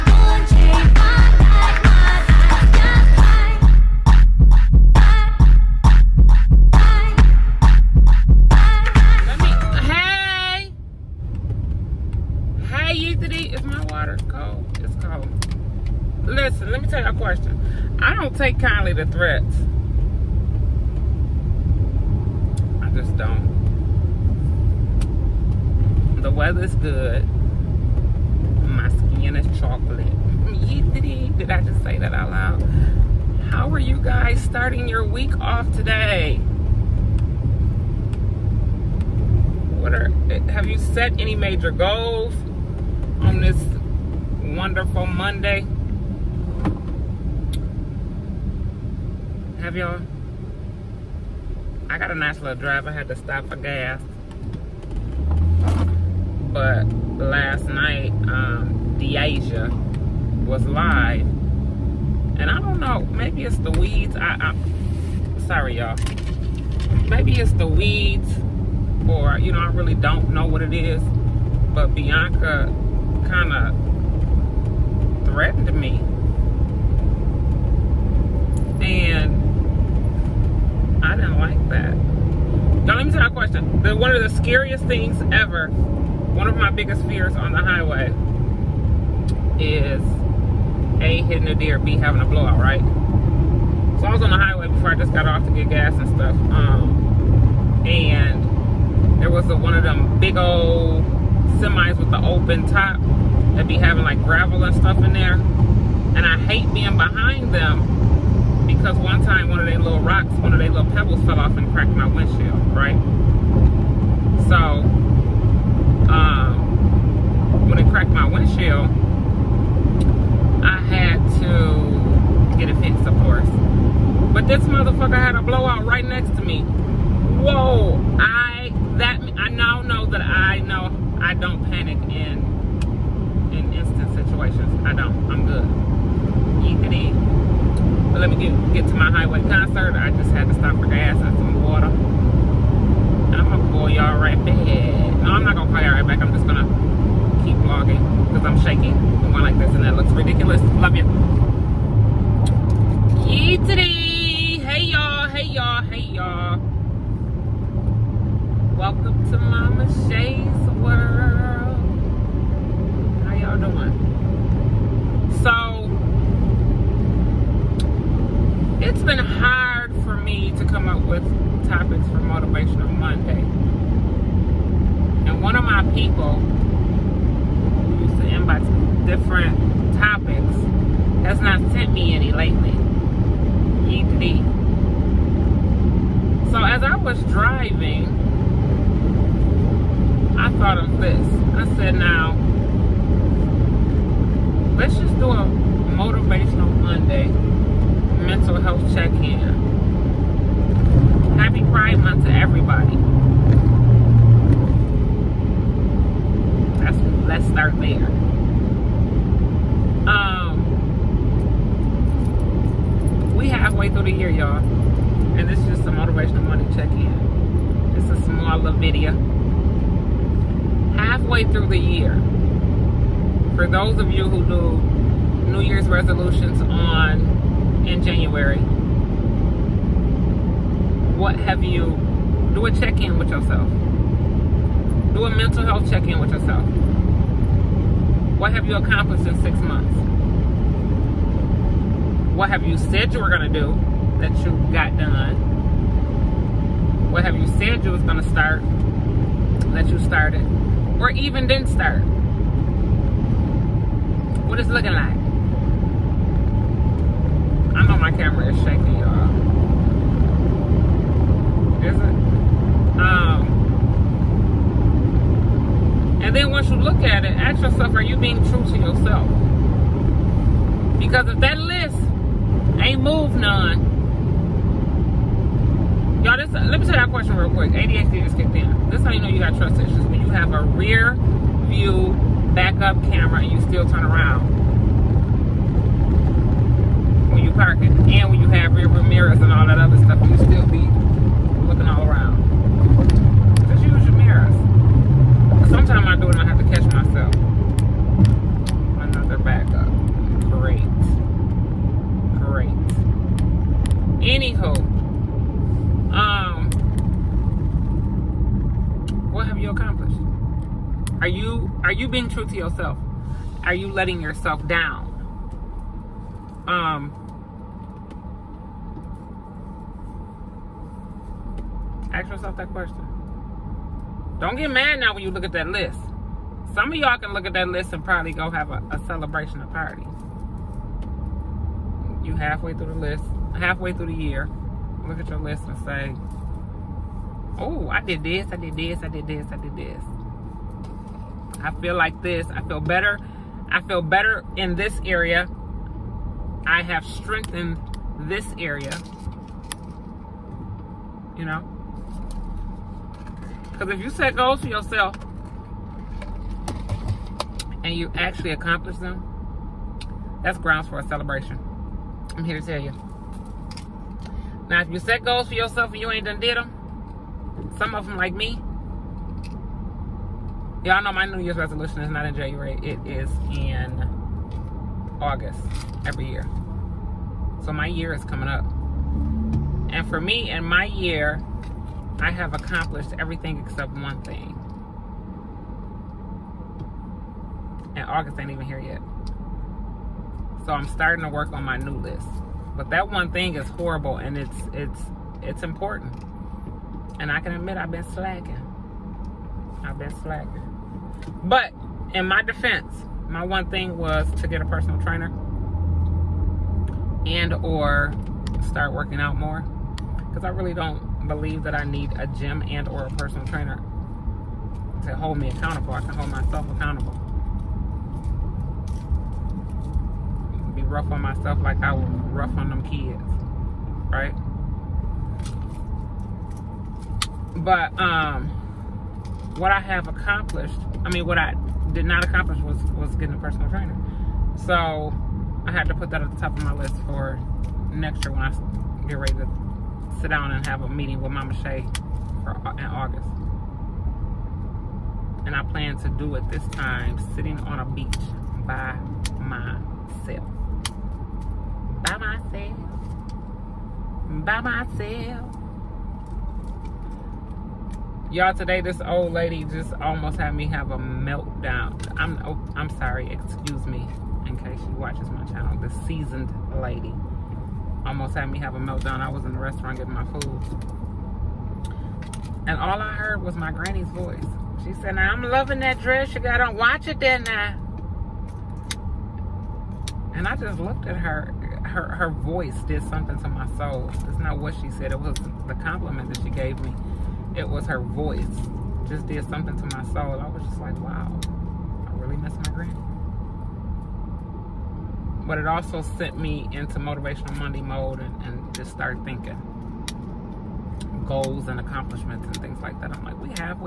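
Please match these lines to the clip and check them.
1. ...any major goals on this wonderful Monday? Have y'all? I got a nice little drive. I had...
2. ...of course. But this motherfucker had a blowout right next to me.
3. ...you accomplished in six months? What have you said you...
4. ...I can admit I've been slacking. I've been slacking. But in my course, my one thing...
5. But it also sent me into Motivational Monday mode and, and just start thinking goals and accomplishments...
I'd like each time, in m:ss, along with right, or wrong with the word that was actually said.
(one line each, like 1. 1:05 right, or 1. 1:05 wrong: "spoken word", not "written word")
1. 0:41 right
2. 2:03 right
3. 3:58 right
4. 6:37 wrong: "defense", not "course"
5. 8:15 right.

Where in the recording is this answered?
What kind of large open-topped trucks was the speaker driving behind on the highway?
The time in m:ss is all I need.
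1:41.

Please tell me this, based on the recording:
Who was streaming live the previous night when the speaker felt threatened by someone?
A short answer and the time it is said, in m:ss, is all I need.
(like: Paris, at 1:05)
Deasia, at 0:58.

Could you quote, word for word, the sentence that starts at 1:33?
So I was on the highway before I just got off to get gas and stuff.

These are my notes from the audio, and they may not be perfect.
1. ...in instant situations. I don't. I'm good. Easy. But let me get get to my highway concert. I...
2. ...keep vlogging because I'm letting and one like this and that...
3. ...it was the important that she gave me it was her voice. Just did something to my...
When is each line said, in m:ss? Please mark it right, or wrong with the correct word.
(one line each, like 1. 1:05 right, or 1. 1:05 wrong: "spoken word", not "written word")
1. 2:13 right
2. 2:27 wrong: "shaking", not "letting"
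3. 8:05 wrong: "compliment", not "important".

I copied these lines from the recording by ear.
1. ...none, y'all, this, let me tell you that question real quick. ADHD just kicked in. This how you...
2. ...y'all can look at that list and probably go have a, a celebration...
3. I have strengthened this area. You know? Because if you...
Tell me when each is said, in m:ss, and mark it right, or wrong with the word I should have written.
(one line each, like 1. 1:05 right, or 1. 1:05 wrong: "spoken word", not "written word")
1. 4:33 right
2. 5:26 right
3. 5:46 right.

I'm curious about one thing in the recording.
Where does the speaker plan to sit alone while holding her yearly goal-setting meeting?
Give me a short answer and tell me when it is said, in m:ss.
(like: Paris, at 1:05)
a beach, at 7:27.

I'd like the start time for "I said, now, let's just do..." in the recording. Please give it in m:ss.
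3:11.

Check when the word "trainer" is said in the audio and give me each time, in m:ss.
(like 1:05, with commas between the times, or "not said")
6:45, 6:53, 7:13.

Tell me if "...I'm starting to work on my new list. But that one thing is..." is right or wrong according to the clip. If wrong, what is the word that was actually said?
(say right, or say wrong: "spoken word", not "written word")
right.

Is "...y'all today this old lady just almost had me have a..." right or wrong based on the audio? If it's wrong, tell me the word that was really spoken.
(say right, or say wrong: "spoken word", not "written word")
right.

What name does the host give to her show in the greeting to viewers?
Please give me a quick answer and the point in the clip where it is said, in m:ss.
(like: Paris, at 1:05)
Momma Shay's World, at 2:39.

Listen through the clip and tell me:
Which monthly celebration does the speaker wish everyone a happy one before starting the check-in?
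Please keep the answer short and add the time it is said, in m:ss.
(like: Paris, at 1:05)
Pride Month, at 3:21.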